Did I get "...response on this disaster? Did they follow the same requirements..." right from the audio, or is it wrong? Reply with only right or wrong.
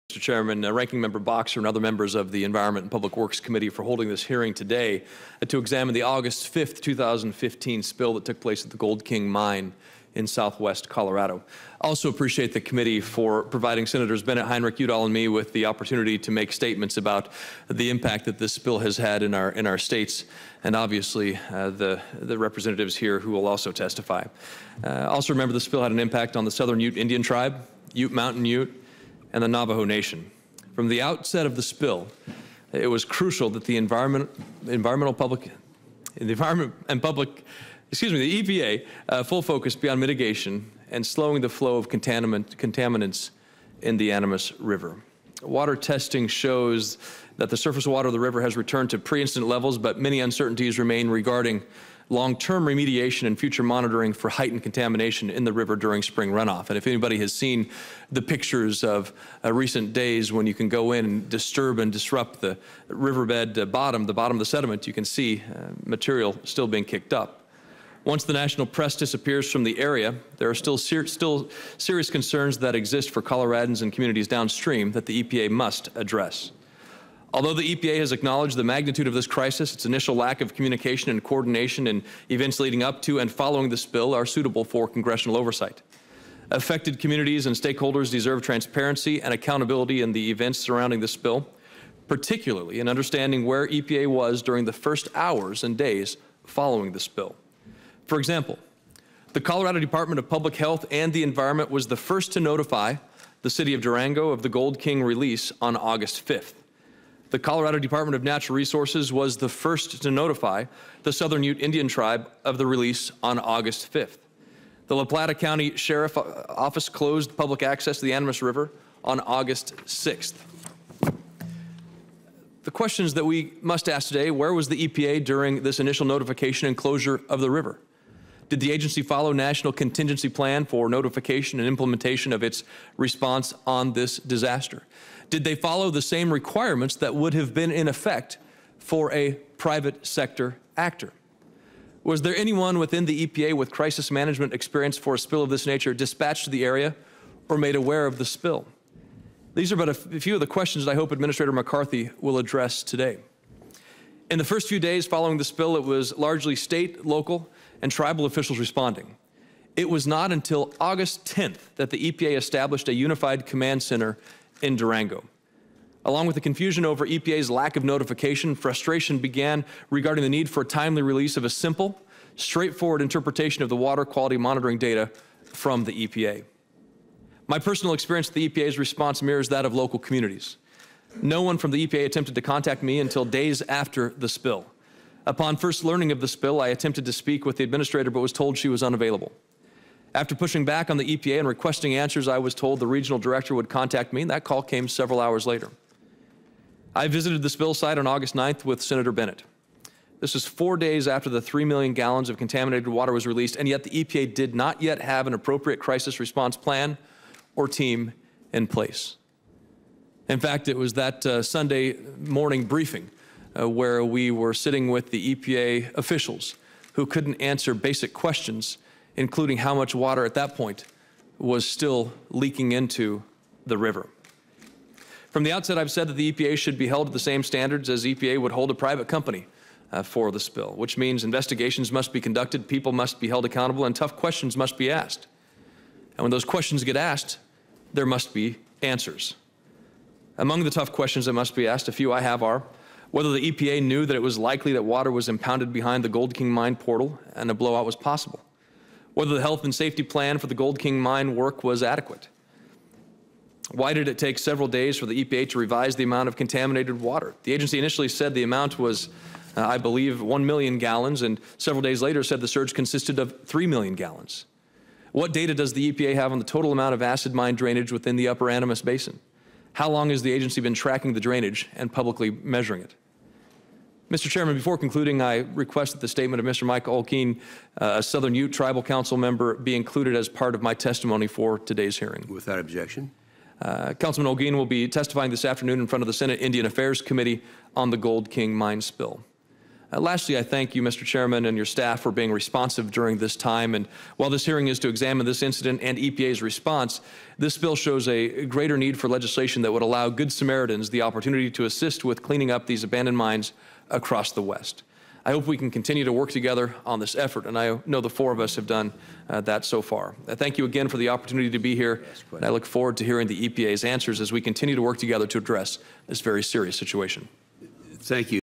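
right.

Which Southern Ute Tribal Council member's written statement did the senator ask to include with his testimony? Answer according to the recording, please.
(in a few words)
Mike Olguin.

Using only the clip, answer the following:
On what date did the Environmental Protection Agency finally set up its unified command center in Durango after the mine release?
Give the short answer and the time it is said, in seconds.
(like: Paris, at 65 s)
August 10th, at 160 s.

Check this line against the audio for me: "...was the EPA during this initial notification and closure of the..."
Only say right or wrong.
right.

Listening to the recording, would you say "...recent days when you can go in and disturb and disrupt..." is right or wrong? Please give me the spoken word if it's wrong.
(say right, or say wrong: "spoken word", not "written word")
right.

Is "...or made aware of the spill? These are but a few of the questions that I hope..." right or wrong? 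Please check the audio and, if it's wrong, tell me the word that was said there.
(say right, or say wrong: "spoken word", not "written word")
right.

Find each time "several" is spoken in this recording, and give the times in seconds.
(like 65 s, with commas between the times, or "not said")
194 s, 254 s, 261 s.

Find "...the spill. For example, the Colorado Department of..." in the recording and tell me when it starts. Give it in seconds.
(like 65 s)
96 s.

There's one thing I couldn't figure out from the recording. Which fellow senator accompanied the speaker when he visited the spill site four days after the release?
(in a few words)
Senator Bennet.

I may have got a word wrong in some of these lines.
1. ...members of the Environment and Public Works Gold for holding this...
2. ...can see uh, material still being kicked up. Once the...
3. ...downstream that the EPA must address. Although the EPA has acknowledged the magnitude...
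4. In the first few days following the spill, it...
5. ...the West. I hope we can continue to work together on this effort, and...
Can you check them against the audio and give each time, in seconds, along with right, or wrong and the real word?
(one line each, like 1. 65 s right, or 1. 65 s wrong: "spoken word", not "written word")
1. 1 s wrong: "Committee", not "Gold"
2. 64 s right
3. 74 s right
4. 154 s right
5. 304 s right.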